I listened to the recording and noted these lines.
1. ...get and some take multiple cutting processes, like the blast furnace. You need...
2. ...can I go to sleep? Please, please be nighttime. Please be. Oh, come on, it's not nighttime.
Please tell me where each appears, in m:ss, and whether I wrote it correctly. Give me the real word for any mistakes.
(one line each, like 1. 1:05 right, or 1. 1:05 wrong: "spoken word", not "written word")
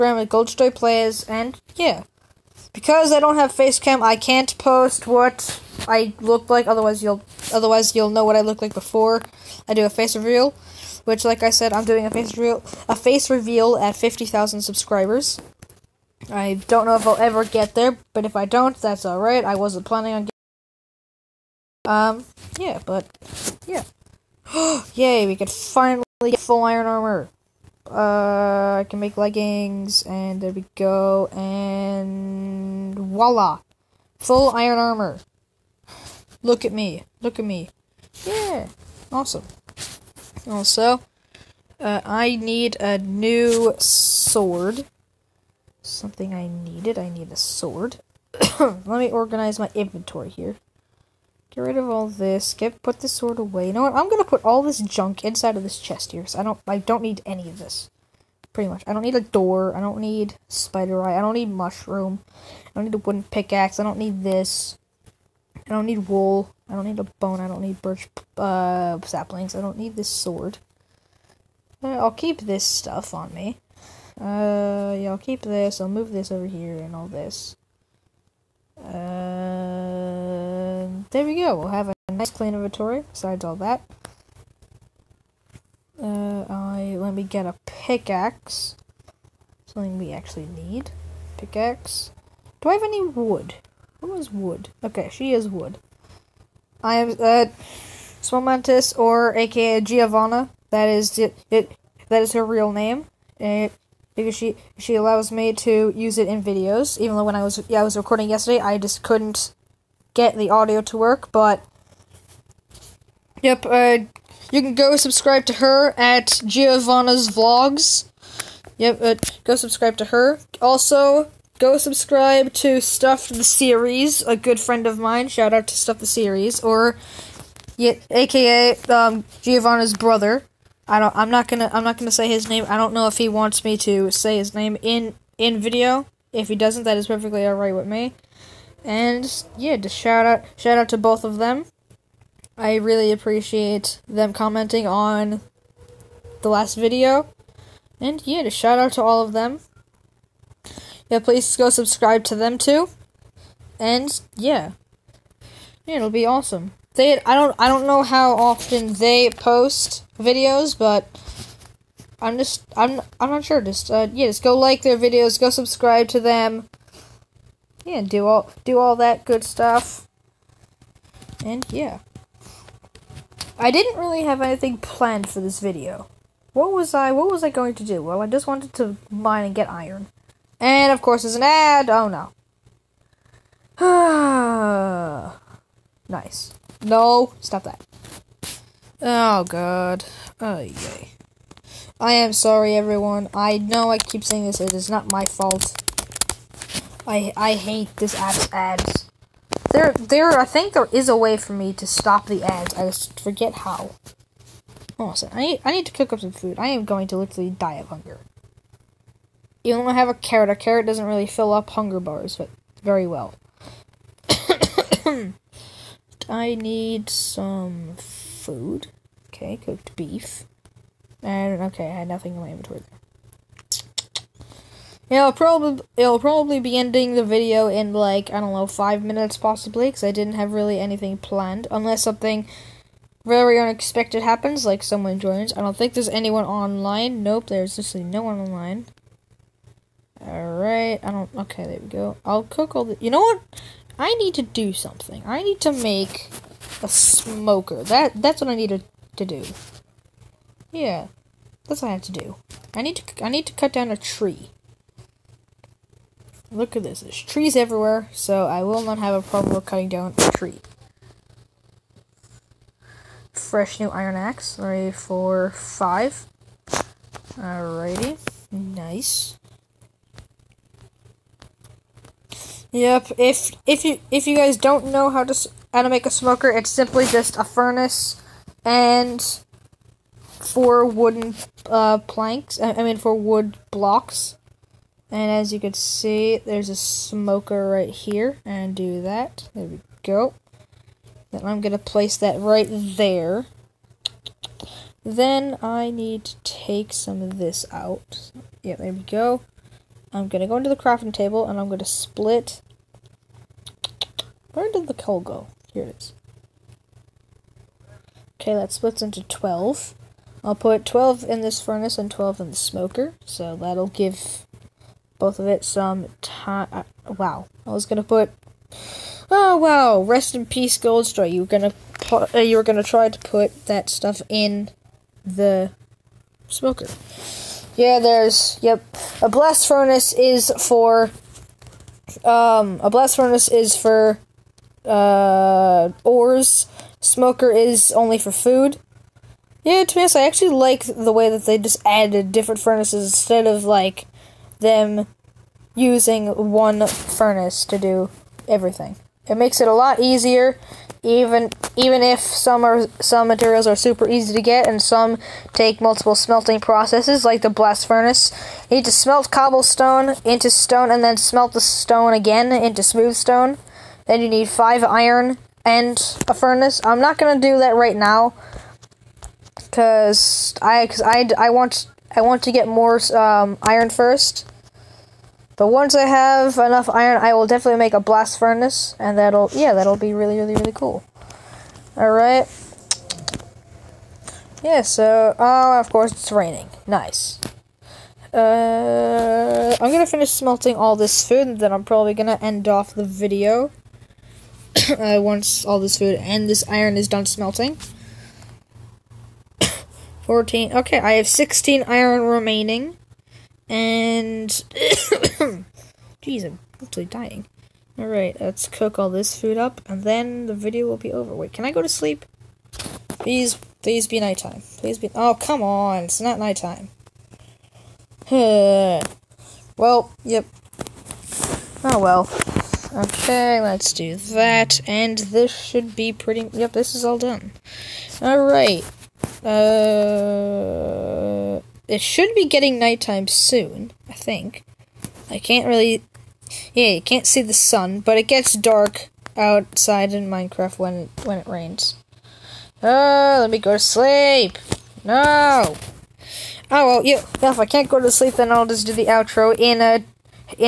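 1. 5:54 wrong: "smelting", not "cutting"
2. 6:51 right.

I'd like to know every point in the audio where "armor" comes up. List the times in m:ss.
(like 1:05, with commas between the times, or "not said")
0:26, 0:34.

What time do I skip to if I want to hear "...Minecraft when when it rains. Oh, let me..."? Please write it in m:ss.
7:20.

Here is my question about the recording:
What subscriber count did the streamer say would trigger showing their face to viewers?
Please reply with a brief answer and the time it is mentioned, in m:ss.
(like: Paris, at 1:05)
50,000, at 0:13.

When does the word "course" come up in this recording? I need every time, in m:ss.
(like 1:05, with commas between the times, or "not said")
3:01, 6:25.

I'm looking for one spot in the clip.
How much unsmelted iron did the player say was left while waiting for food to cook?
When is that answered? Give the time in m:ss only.
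6:41.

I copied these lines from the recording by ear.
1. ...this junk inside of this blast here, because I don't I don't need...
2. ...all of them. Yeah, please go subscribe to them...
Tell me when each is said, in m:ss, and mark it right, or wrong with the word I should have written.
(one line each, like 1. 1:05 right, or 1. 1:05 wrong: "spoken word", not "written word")
1. 0:54 wrong: "chest", not "blast"
2. 2:29 right.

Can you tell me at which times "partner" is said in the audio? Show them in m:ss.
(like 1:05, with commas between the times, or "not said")
not said.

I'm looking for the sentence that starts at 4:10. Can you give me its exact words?
Yeah, that's what I have to do.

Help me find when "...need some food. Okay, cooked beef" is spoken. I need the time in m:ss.
3:36.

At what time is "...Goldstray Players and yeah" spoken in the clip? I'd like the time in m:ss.
0:00.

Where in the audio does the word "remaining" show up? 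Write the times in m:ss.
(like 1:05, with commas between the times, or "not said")
6:42.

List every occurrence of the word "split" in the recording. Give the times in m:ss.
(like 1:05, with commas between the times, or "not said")
5:01, 5:08.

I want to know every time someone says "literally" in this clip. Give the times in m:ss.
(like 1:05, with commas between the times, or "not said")
3:27, 3:57.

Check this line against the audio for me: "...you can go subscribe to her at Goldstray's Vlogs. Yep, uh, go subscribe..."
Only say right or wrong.
wrong.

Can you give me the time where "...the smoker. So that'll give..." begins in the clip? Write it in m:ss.
5:12.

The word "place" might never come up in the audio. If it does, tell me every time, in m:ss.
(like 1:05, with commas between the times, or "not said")
4:51.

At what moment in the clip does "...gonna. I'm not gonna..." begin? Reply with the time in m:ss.
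2:11.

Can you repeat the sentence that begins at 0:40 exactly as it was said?
Also, uh, I need a new sword.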